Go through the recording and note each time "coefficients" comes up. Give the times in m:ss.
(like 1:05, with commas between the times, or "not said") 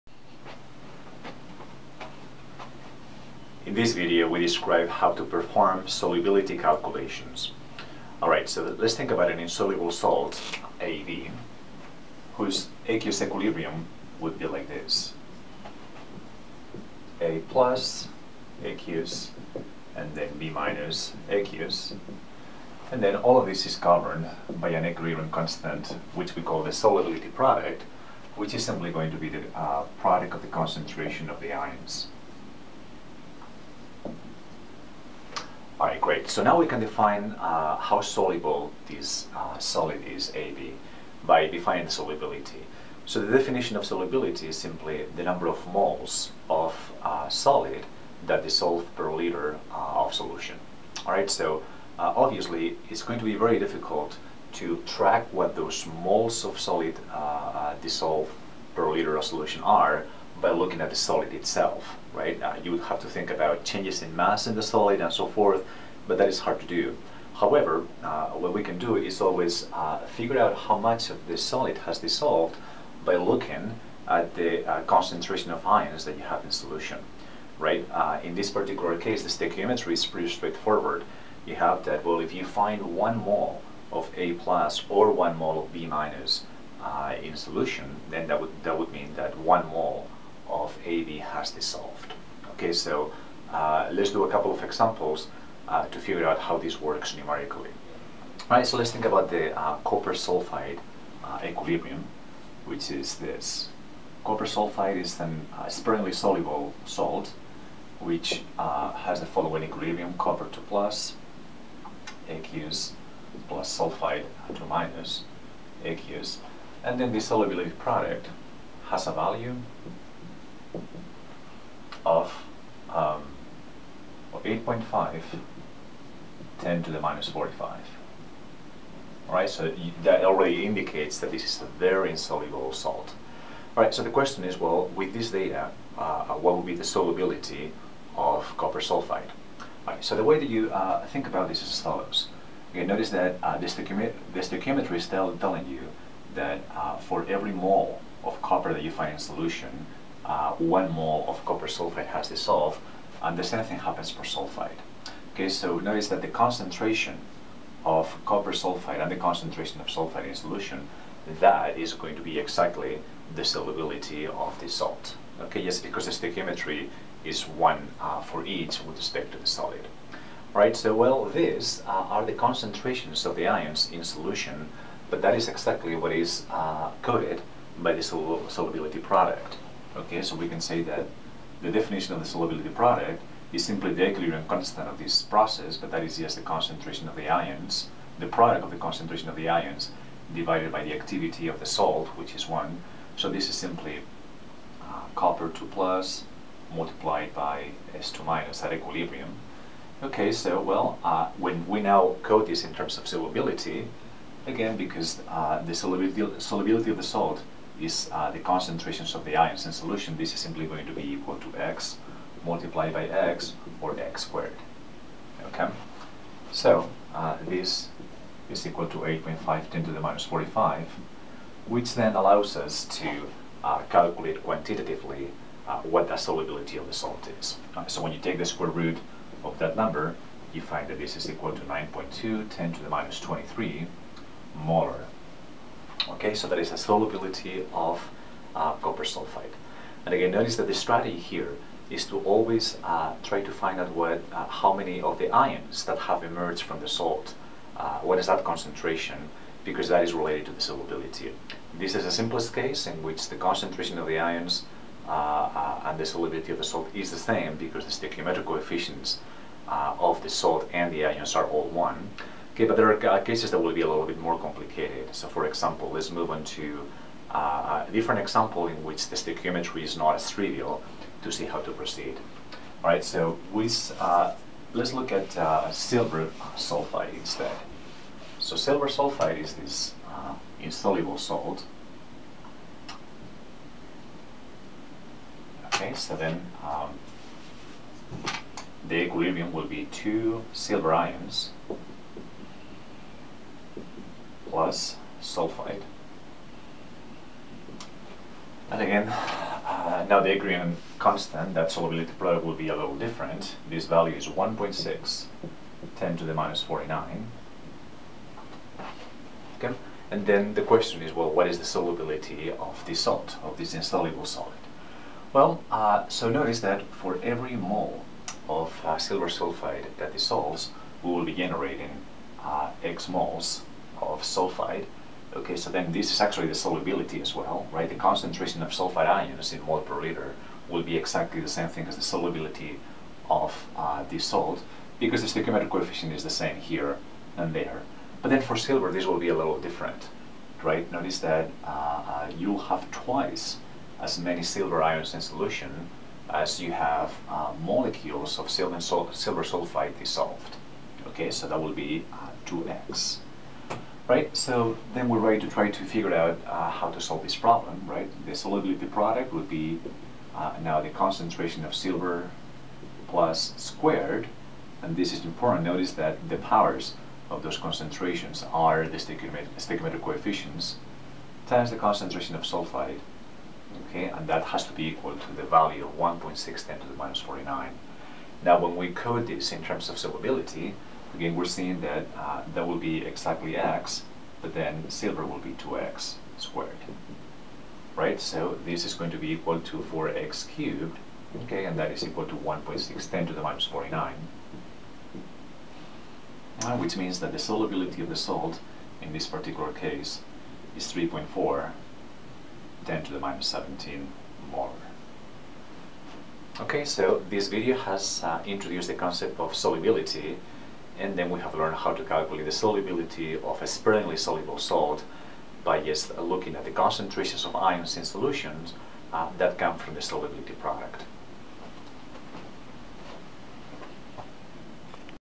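4:18, 5:35, 6:10.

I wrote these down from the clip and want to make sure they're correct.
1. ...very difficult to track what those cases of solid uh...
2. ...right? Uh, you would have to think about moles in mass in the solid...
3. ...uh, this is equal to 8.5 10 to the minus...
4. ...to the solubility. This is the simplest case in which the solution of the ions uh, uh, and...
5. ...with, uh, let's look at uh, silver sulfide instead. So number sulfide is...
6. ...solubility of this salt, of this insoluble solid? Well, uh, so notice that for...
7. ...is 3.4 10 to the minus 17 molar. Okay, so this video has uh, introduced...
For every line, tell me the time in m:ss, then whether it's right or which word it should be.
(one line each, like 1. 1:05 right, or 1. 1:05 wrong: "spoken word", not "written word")
1. 0:53 wrong: "moles", not "cases"
2. 1:02 wrong: "changes", not "moles"
3. 3:37 right
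4. 4:10 wrong: "concentration", not "solution"
5. 4:33 wrong: "silver", not "number"
6. 5:11 right
7. 6:40 right.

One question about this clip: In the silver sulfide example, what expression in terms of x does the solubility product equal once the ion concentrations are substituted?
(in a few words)
4x cubed.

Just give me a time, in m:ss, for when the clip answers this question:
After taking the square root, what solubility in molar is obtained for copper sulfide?
3:51.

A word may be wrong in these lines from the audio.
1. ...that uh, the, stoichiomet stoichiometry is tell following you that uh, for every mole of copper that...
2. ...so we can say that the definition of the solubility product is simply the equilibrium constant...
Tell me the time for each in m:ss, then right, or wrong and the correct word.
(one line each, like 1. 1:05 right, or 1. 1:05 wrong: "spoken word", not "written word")
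1. 2:23 wrong: "telling", not "following"
2. 3:00 right.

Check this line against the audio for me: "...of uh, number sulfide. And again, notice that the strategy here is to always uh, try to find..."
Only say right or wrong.
wrong.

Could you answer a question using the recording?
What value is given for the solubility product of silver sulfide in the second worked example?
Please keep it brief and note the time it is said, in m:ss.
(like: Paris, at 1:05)
1.6 × 10^-49, at 5:04.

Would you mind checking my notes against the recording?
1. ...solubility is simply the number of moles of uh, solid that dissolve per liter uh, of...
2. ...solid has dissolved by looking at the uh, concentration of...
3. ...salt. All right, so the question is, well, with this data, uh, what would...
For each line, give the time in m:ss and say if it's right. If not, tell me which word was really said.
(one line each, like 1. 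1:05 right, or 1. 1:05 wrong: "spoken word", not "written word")
1. 0:43 right
2. 1:11 right
3. 2:12 right.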